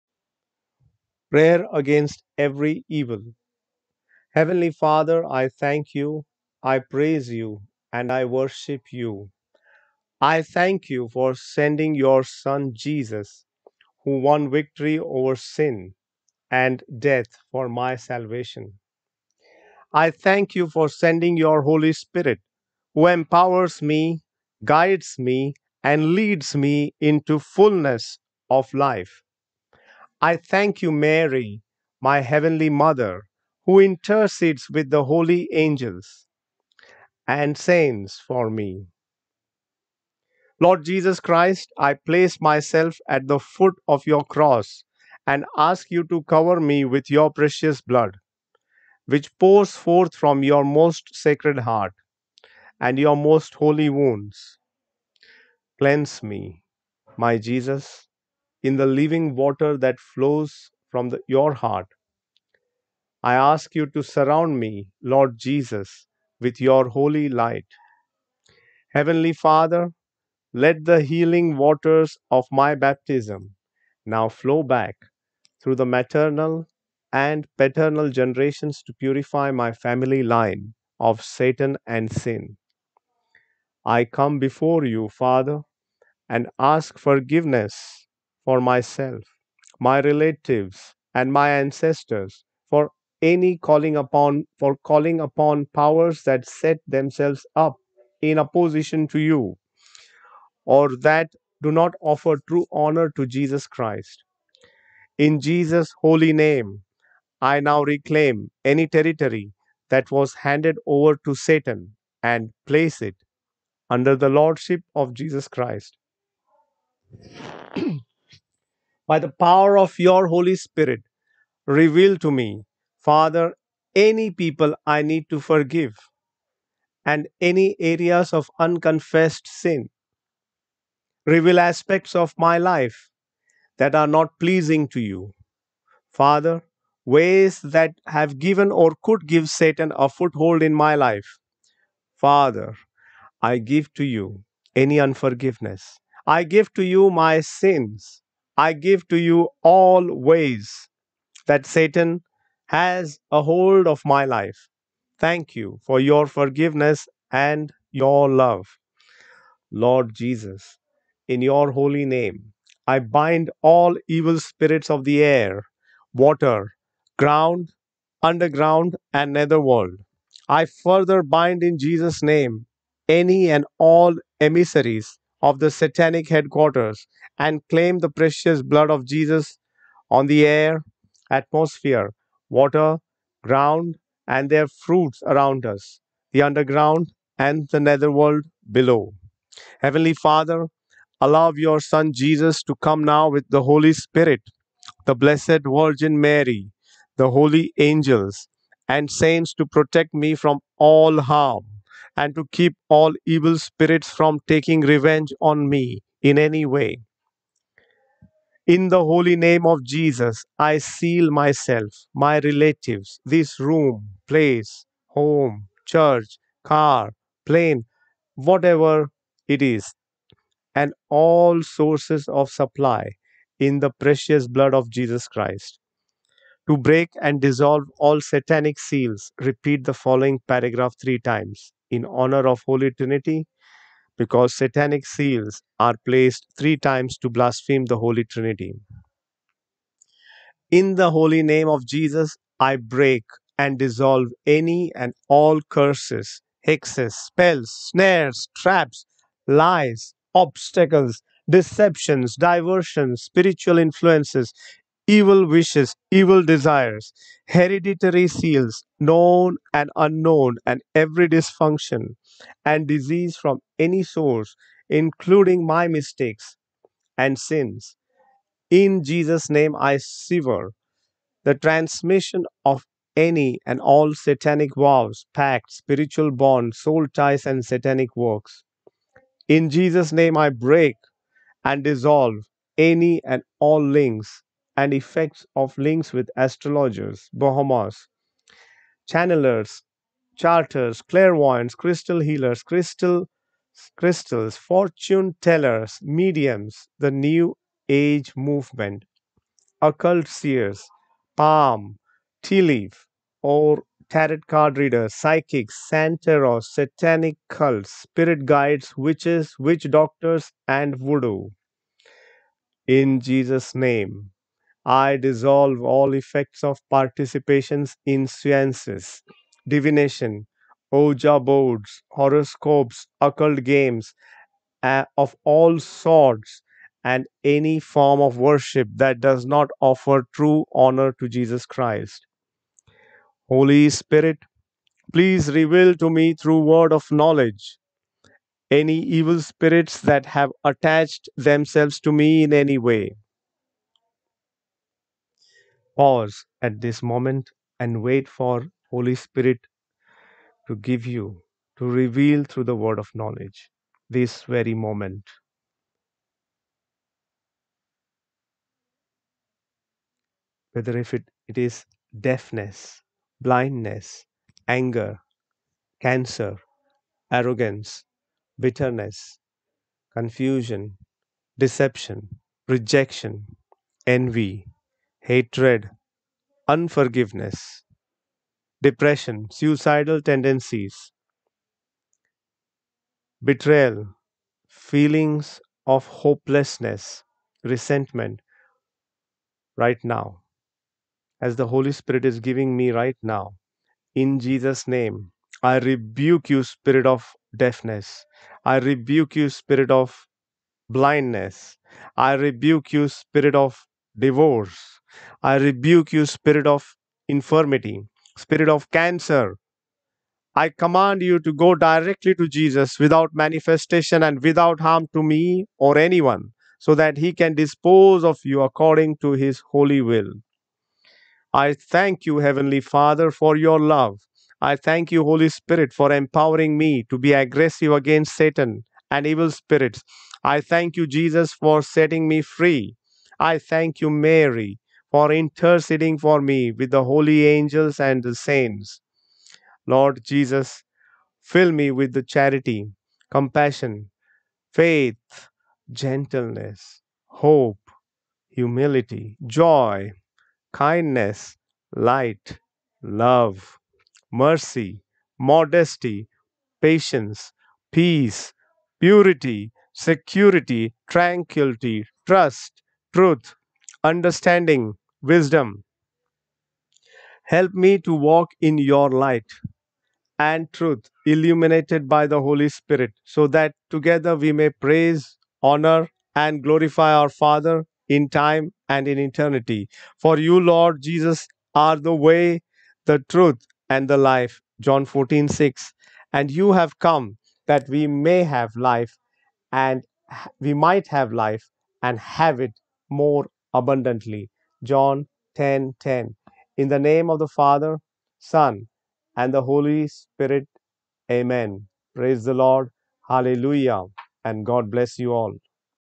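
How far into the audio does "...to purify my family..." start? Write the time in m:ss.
1:18.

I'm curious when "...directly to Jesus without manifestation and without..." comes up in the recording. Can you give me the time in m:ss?
6:51.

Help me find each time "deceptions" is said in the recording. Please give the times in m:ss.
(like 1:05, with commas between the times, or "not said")
4:11, 6:11.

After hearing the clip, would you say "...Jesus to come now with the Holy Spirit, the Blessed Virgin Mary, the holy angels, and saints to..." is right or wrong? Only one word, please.
right.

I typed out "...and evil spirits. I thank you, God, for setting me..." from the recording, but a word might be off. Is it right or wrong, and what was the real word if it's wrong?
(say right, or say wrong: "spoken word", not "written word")
wrong: "Jesus", not "God".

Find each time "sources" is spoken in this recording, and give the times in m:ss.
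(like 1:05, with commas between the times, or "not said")
3:41, 4:24.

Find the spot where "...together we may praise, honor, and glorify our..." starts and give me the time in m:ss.
7:53.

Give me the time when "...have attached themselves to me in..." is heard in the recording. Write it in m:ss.
5:40.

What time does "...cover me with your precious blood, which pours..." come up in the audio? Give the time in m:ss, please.
0:46.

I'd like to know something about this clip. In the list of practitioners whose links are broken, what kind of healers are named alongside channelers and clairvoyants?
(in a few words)
Crystal healers.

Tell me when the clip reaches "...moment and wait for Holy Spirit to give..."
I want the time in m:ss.
5:47.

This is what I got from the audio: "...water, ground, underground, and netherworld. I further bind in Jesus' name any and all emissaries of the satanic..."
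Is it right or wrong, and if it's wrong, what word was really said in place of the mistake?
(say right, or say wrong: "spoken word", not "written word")
right.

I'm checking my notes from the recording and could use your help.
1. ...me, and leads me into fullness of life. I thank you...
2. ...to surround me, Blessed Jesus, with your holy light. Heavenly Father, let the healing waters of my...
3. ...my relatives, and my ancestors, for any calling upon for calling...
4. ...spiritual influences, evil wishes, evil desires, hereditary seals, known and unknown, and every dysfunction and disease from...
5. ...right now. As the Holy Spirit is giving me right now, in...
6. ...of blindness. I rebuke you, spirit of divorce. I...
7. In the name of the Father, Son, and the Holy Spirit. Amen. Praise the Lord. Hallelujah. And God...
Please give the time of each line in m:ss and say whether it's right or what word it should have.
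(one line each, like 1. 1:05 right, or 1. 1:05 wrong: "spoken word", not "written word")
1. 0:25 right
2. 1:03 wrong: "Lord", not "Blessed"
3. 1:29 right
4. 4:13 right
5. 6:29 right
6. 6:39 right
7. 8:16 right.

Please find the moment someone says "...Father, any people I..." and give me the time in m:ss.
2:03.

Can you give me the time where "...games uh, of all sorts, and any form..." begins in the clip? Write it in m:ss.
5:23.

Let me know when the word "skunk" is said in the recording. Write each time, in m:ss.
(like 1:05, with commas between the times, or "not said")
not said.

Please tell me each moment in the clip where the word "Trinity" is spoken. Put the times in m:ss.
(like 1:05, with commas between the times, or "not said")
3:52, 3:58.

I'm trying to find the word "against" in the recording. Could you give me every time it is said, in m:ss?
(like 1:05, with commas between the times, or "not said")
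0:01, 7:07.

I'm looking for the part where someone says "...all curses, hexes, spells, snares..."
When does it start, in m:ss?
4:05.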